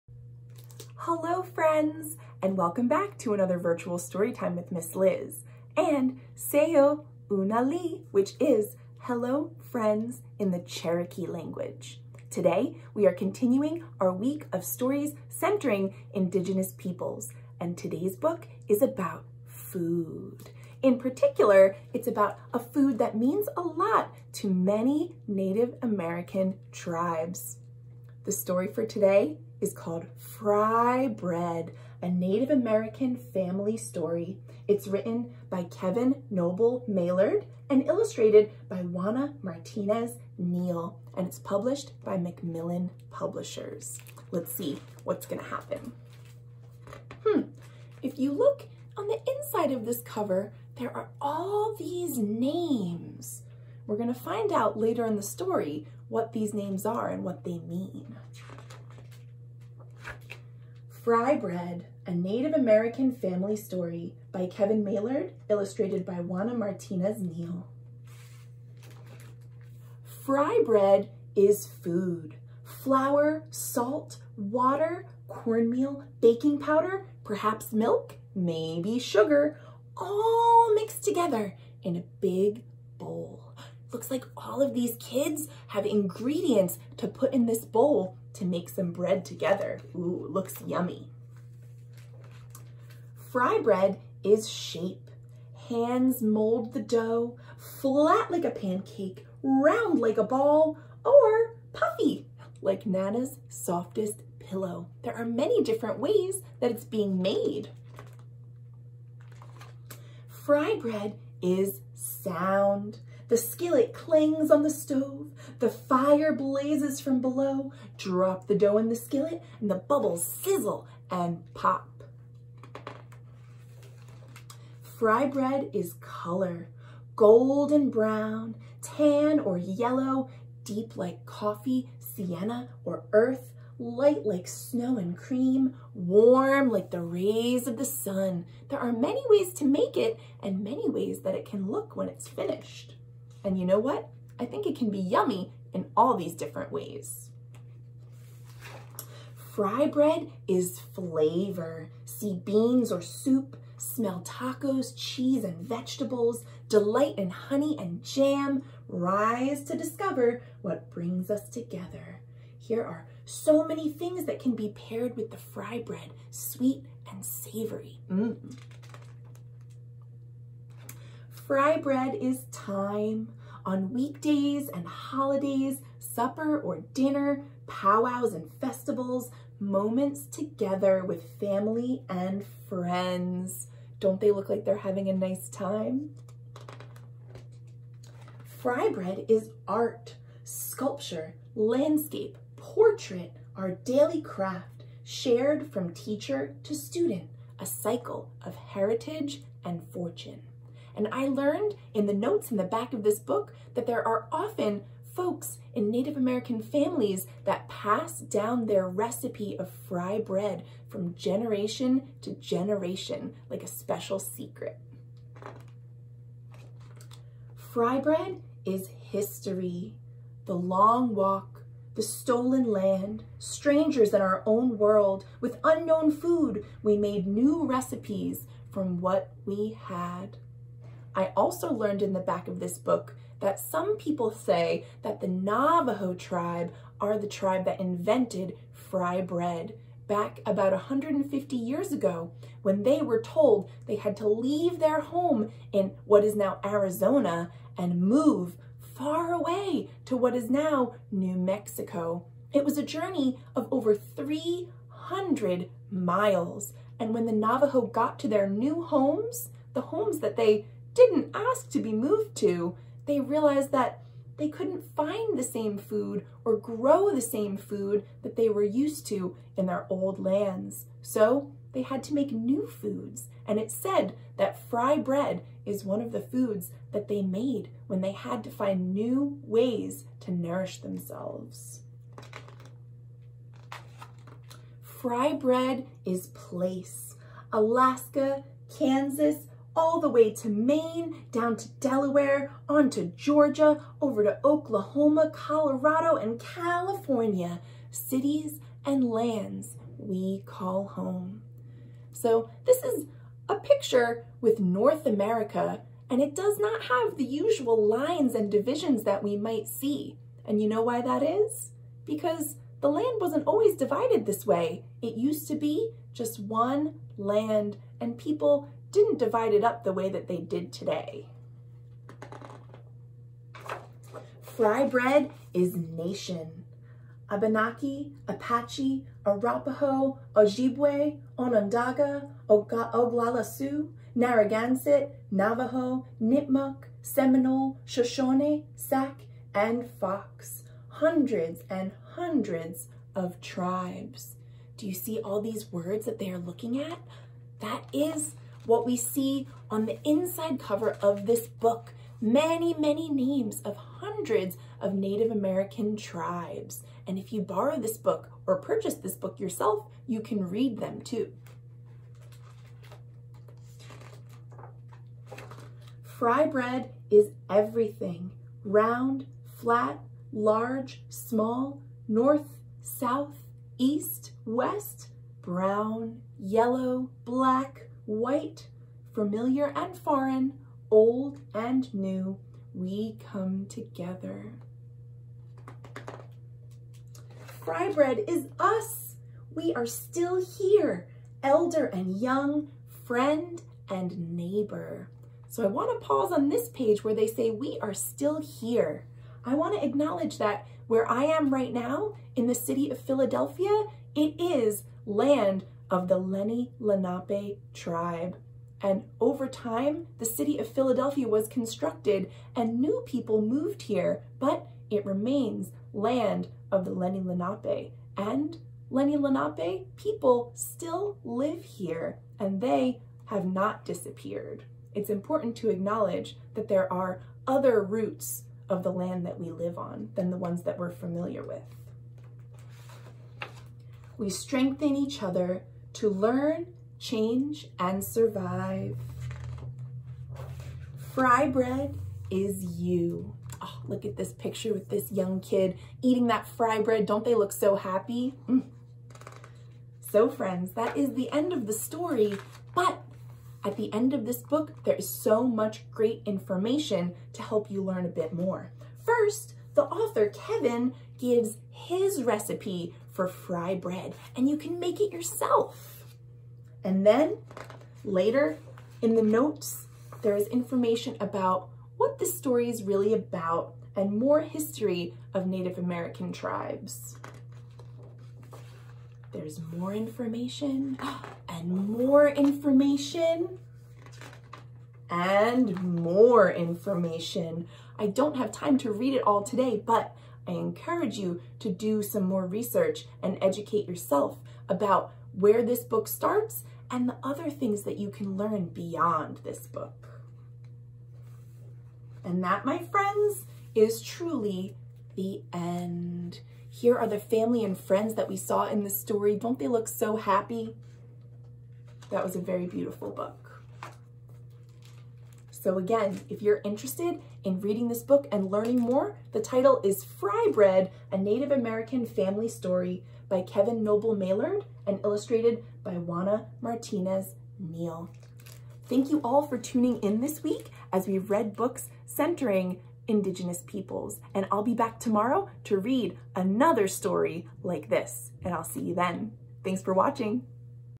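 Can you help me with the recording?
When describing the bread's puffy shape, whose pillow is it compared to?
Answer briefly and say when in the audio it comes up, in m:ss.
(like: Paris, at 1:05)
Nana's, at 1:42.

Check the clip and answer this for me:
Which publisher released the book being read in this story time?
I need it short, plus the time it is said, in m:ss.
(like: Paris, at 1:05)
Macmillan Publishers, at 0:42.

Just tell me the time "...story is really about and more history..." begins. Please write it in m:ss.
7:52.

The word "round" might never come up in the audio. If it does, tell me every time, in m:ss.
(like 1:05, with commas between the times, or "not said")
1:39, 6:08.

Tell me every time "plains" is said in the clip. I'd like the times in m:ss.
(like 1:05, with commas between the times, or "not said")
not said.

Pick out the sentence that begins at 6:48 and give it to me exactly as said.
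And over time, the city of Philadelphia was constructed and new people moved here, but it remains land of the Lenni Lenape.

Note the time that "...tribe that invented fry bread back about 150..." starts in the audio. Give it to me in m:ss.
3:57.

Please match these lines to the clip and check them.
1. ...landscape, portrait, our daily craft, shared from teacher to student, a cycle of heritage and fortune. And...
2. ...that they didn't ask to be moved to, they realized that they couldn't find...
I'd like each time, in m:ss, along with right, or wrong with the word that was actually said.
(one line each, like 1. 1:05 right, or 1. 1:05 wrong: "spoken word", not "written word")
1. 3:11 right
2. 4:20 right.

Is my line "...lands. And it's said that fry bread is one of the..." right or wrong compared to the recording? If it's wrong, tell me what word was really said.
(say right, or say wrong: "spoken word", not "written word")
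wrong: "foods", not "lands".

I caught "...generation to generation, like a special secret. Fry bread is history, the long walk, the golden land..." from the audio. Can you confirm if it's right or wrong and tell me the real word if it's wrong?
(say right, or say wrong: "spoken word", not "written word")
wrong: "stolen", not "golden".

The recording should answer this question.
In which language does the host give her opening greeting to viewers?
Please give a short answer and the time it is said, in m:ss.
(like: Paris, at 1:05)
Cherokee, at 0:10.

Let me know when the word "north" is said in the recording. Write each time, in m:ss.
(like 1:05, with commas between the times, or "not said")
5:04, 6:12.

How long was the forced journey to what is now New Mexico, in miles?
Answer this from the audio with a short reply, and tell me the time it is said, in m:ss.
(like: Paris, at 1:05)
over 300 miles, at 4:13.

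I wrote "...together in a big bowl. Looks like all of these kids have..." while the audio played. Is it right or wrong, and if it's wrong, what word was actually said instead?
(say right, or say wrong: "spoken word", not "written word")
right.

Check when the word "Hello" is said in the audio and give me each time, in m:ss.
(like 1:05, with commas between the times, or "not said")
0:01, 0:08.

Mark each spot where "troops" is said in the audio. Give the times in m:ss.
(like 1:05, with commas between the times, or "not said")
not said.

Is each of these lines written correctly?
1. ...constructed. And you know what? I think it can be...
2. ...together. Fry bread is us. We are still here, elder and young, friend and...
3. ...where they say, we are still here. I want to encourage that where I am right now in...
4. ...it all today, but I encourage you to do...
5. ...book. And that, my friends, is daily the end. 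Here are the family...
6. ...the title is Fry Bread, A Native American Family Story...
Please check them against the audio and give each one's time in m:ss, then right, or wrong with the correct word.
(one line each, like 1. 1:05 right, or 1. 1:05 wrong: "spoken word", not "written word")
1. 2:22 wrong: "finished", not "constructed"
2. 6:23 right
3. 6:37 wrong: "acknowledge", not "encourage"
4. 8:09 right
5. 8:19 wrong: "truly", not "daily"
6. 8:39 right.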